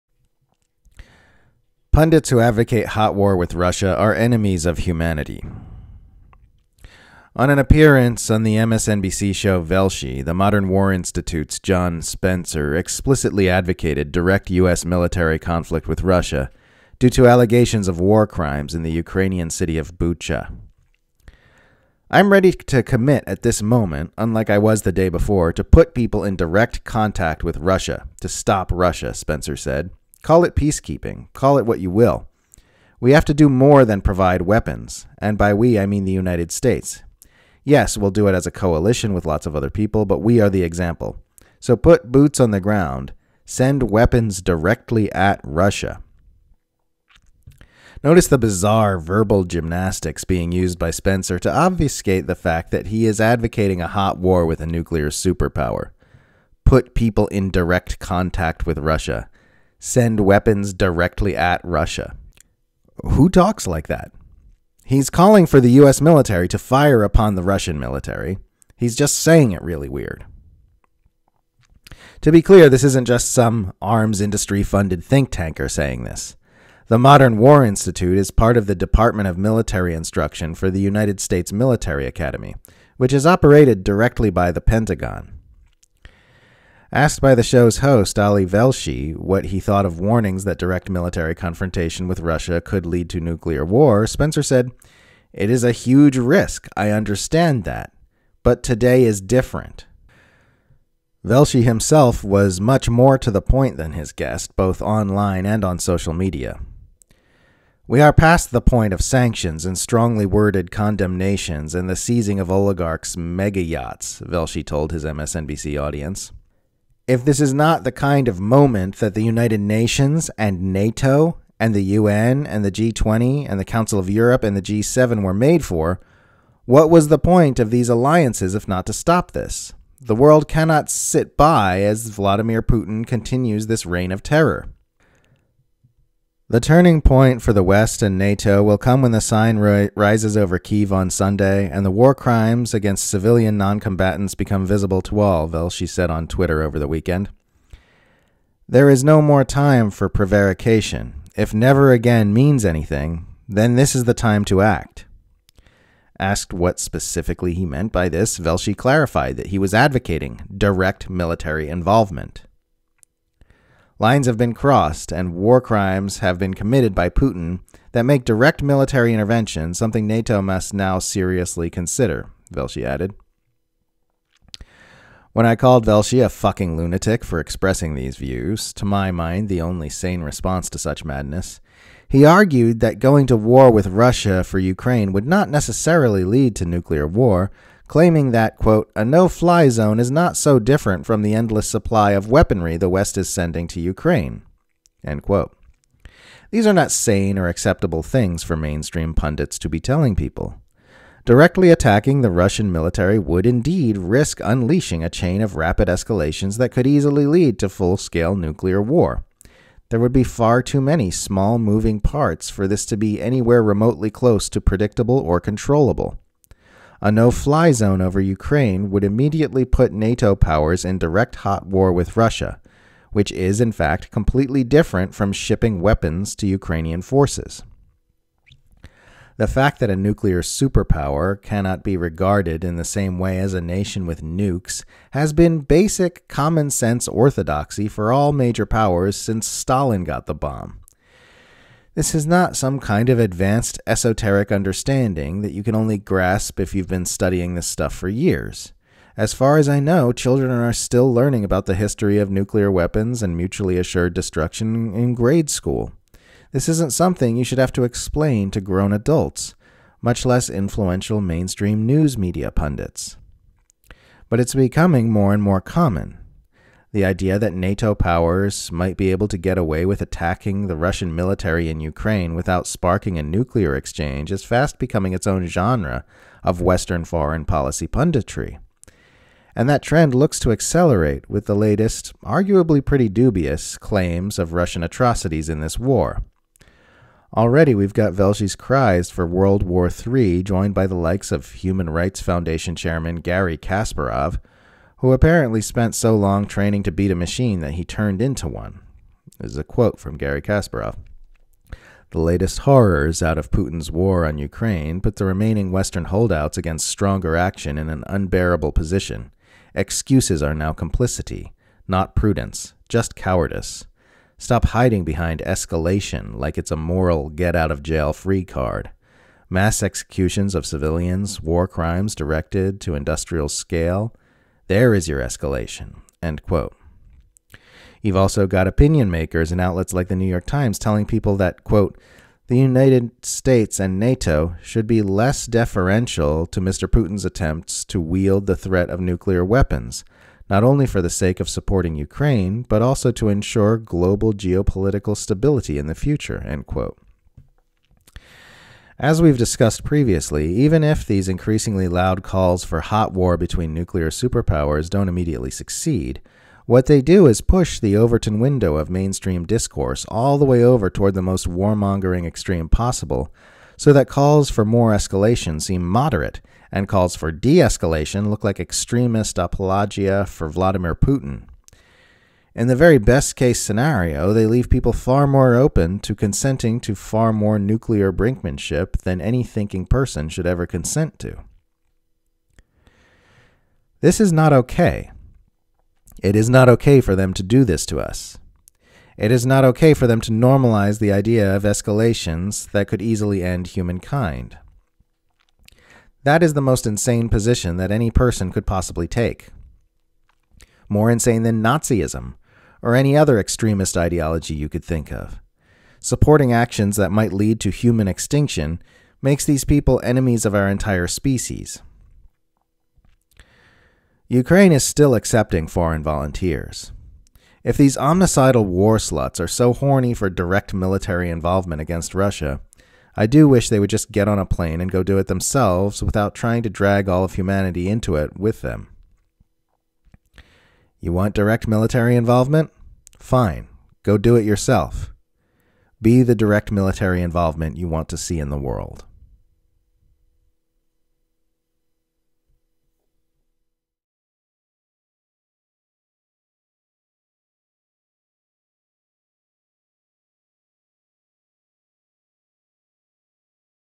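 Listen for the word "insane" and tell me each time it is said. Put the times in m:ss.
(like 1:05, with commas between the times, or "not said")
6:36, 6:41.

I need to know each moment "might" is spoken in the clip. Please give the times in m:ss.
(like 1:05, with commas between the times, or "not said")
4:28, 6:47.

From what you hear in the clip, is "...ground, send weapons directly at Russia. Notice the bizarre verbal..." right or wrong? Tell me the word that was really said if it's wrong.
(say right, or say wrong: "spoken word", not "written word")
right.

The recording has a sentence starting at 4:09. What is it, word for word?
As far as I know, children are still learning about the history of nuclear weapons and mutually assured destruction in grade school.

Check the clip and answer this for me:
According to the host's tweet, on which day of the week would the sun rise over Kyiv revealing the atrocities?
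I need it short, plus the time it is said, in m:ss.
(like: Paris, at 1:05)
Sunday, at 2:21.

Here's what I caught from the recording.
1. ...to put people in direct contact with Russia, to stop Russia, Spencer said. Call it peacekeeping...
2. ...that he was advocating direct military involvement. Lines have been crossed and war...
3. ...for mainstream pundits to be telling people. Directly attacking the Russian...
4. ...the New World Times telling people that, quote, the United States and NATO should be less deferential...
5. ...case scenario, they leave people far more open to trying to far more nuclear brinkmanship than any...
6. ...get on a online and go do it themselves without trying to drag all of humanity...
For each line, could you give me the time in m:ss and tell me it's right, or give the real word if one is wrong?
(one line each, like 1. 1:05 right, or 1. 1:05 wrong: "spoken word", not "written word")
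1. 0:25 right
2. 2:39 right
3. 3:18 right
4. 5:30 wrong: "York", not "World"
5. 6:13 wrong: "consenting", not "trying"
6. 7:04 wrong: "plane", not "online".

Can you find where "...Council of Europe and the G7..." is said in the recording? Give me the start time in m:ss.
2:03.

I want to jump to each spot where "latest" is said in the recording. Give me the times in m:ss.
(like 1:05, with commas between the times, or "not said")
4:41, 5:02.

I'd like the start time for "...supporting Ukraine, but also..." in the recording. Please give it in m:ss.
5:41.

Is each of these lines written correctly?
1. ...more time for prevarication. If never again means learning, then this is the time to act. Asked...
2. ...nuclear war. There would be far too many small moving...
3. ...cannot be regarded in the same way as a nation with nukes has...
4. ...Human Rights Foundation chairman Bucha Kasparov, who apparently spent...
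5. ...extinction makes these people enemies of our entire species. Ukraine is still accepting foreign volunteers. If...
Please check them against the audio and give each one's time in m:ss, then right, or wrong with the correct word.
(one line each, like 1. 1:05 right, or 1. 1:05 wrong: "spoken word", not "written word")
1. 2:29 wrong: "anything", not "learning"
2. 3:28 right
3. 3:51 right
4. 4:51 wrong: "Garry", not "Bucha"
5. 6:48 right.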